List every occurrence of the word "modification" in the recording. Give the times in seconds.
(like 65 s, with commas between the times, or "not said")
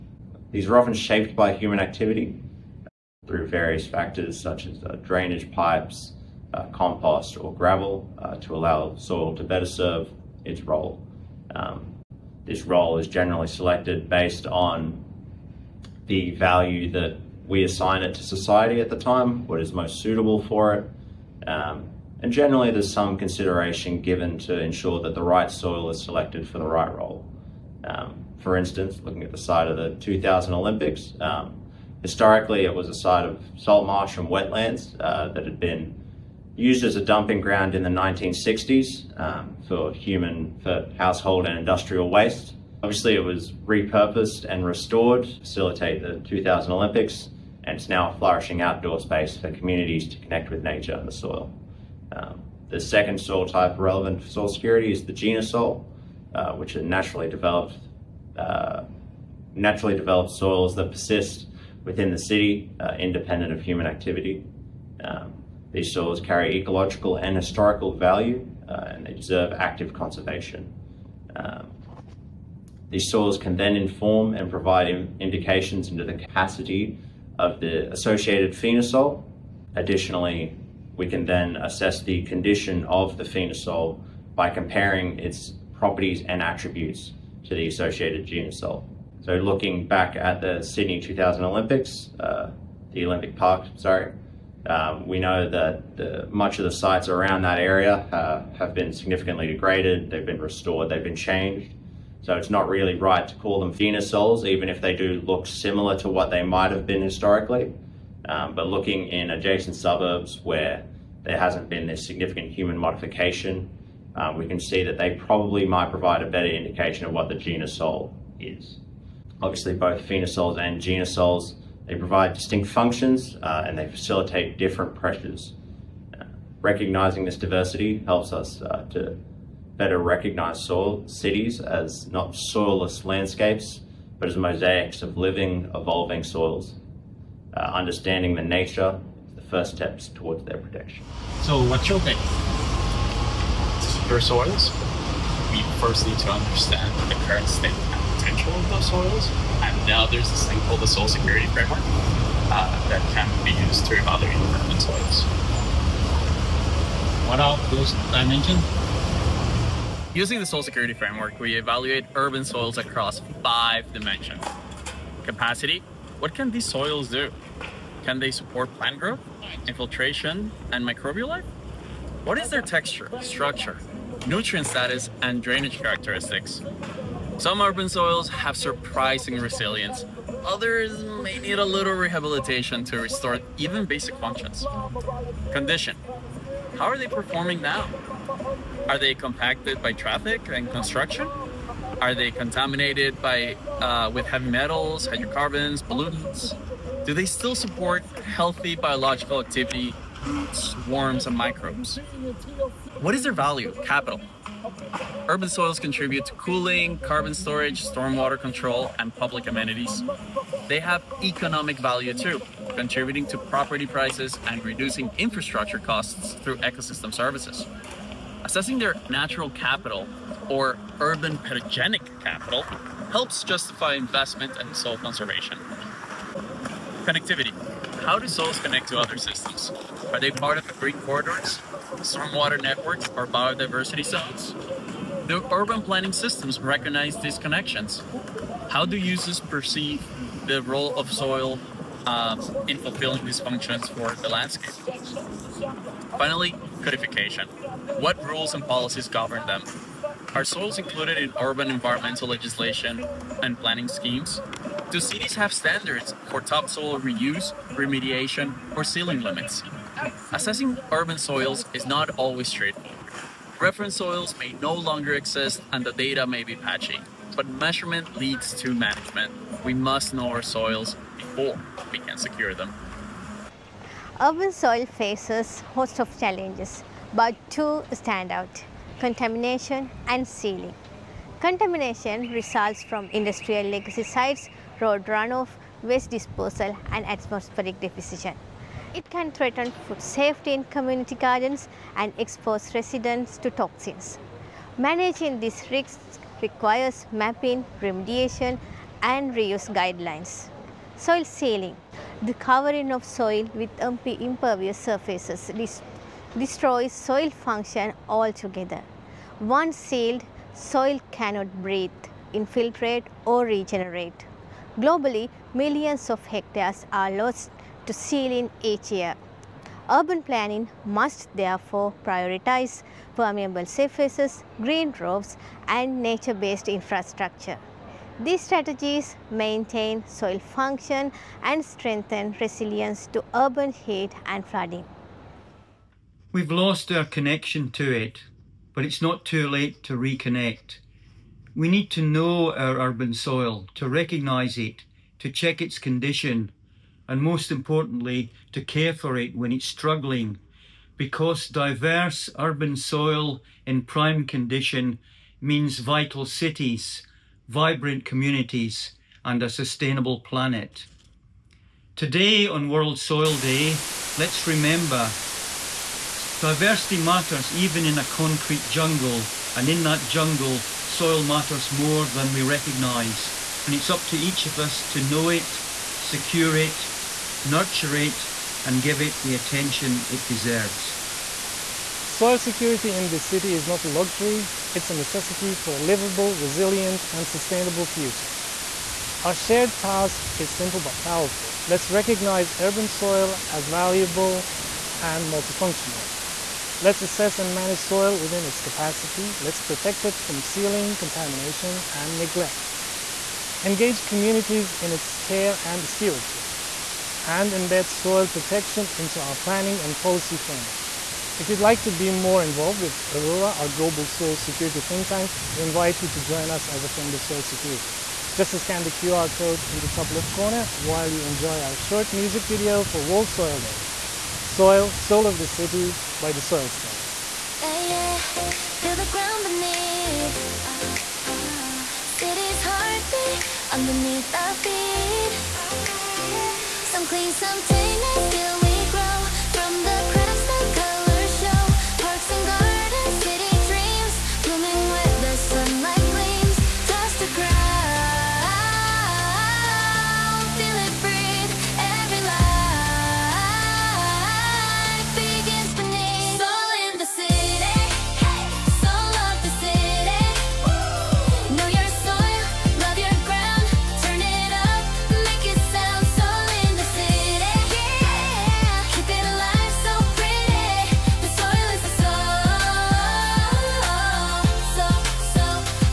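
112 s.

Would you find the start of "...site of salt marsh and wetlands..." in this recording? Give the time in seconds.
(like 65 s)
32 s.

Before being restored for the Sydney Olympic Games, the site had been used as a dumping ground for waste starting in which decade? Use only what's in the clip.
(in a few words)
1960s.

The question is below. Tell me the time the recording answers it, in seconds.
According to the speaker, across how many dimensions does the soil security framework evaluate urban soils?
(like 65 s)
163 s.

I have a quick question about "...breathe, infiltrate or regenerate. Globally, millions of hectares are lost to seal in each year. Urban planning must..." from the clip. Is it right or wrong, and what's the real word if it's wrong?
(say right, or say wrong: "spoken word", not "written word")
right.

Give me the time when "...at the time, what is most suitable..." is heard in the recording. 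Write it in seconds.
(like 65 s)
18 s.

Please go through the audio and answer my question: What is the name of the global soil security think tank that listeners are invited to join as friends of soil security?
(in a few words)
Aroura.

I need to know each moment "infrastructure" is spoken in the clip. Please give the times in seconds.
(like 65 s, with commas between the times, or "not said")
215 s, 326 s.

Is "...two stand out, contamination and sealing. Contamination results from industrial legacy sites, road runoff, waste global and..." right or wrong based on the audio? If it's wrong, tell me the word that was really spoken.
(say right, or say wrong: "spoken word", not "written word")
wrong: "disposal", not "global".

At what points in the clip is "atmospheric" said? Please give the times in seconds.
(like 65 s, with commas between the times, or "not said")
287 s.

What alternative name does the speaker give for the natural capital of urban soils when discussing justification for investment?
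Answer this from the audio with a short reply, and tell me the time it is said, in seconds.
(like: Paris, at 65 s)
urban pedogenic capital, at 221 s.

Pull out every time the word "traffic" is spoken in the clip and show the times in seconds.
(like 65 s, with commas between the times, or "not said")
189 s.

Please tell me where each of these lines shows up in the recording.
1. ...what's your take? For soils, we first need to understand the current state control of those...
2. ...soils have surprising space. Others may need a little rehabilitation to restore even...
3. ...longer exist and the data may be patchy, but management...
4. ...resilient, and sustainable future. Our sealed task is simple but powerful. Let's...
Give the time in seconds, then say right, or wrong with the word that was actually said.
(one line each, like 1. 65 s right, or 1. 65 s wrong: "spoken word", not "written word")
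1. 141 s right
2. 177 s wrong: "resilience", not "space"
3. 264 s wrong: "measurement", not "management"
4. 386 s wrong: "shared", not "sealed".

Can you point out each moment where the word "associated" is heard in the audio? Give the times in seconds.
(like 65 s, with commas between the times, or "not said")
77 s, 87 s.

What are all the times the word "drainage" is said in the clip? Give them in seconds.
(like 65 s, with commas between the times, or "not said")
5 s, 175 s.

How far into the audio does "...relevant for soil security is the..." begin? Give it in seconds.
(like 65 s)
53 s.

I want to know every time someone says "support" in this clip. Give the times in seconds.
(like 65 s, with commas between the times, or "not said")
168 s, 197 s.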